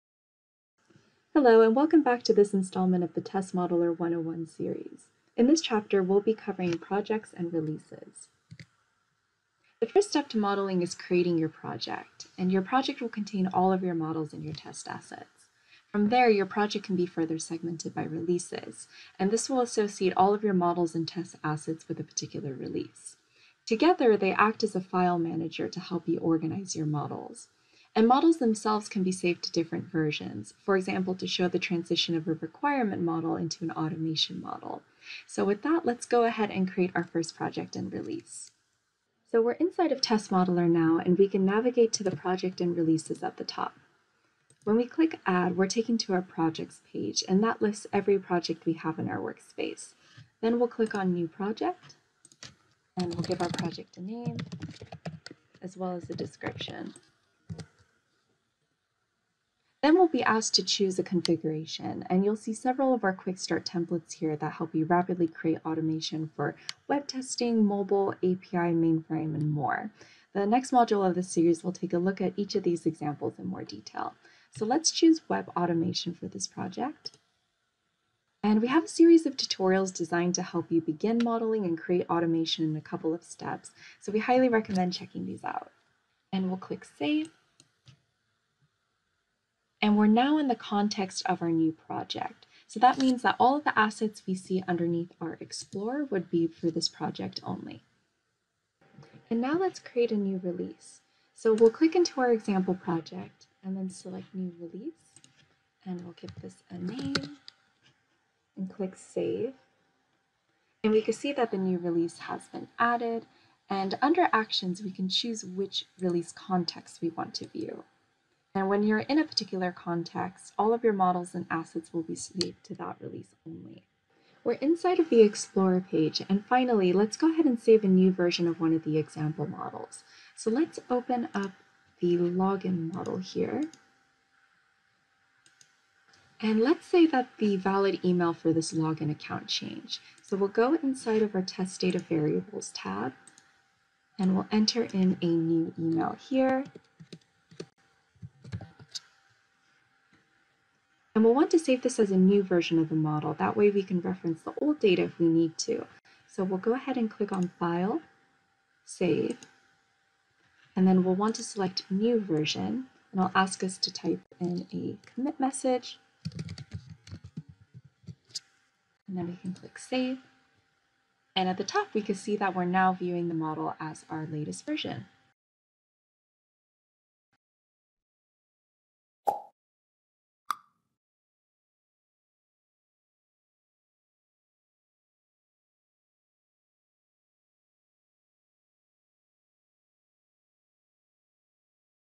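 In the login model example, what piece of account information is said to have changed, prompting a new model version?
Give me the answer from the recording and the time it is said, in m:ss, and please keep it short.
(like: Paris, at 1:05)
The valid email, at 2:17.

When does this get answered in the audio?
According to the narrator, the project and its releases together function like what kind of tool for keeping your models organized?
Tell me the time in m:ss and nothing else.
0:24.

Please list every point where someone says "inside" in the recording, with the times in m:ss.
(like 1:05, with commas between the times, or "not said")
0:39, 2:04, 2:20.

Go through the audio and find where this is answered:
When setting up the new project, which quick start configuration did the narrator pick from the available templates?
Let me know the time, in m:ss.
1:15.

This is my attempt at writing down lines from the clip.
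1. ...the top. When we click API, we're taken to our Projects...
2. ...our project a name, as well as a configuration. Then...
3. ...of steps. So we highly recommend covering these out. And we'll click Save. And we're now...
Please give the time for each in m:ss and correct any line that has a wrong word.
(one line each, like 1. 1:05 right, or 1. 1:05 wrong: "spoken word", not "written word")
1. 0:43 wrong: "Add", not "API"
2. 0:53 wrong: "description", not "configuration"
3. 1:23 wrong: "checking", not "covering".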